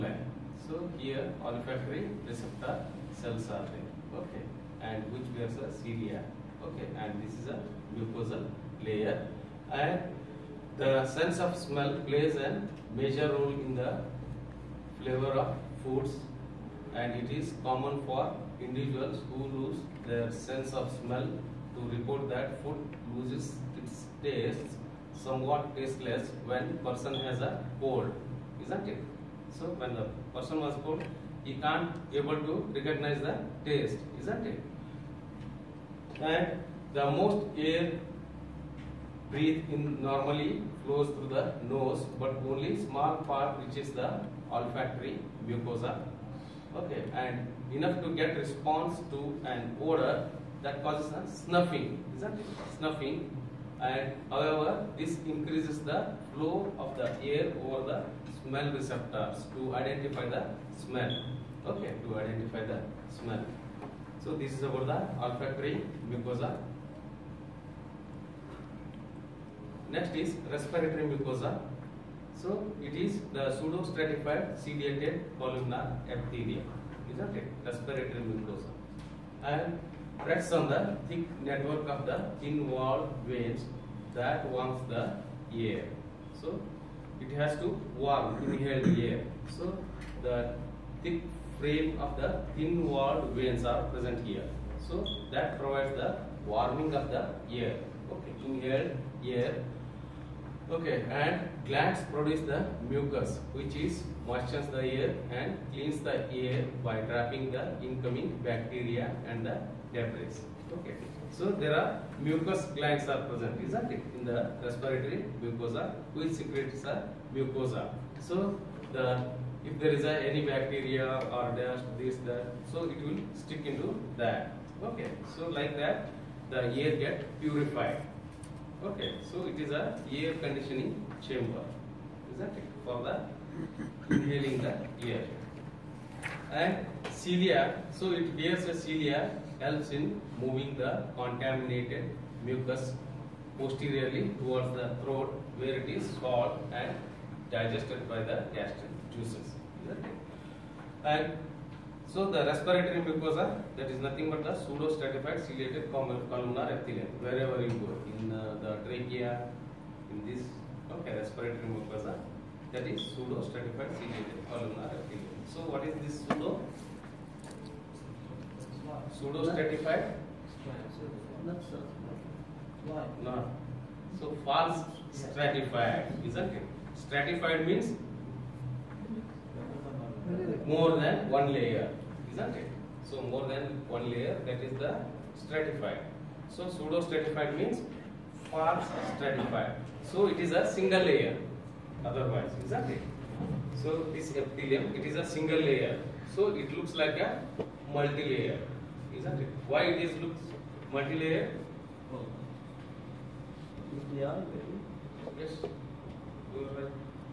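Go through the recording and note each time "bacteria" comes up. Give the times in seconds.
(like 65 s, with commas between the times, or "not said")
108 s, 120 s.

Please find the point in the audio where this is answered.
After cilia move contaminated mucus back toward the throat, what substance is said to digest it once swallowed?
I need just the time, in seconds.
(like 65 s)
148 s.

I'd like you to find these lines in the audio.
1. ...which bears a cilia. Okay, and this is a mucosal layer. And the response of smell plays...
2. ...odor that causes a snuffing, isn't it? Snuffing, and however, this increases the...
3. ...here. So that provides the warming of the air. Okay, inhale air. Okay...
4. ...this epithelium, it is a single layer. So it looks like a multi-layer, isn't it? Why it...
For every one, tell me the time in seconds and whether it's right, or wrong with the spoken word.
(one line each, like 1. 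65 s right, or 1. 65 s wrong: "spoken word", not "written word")
1. 5 s wrong: "sense", not "response"
2. 49 s right
3. 94 s right
4. 194 s right.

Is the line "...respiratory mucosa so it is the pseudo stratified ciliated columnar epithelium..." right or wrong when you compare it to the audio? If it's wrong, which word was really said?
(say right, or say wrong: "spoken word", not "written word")
right.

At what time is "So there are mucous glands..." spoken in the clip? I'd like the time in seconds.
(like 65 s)
111 s.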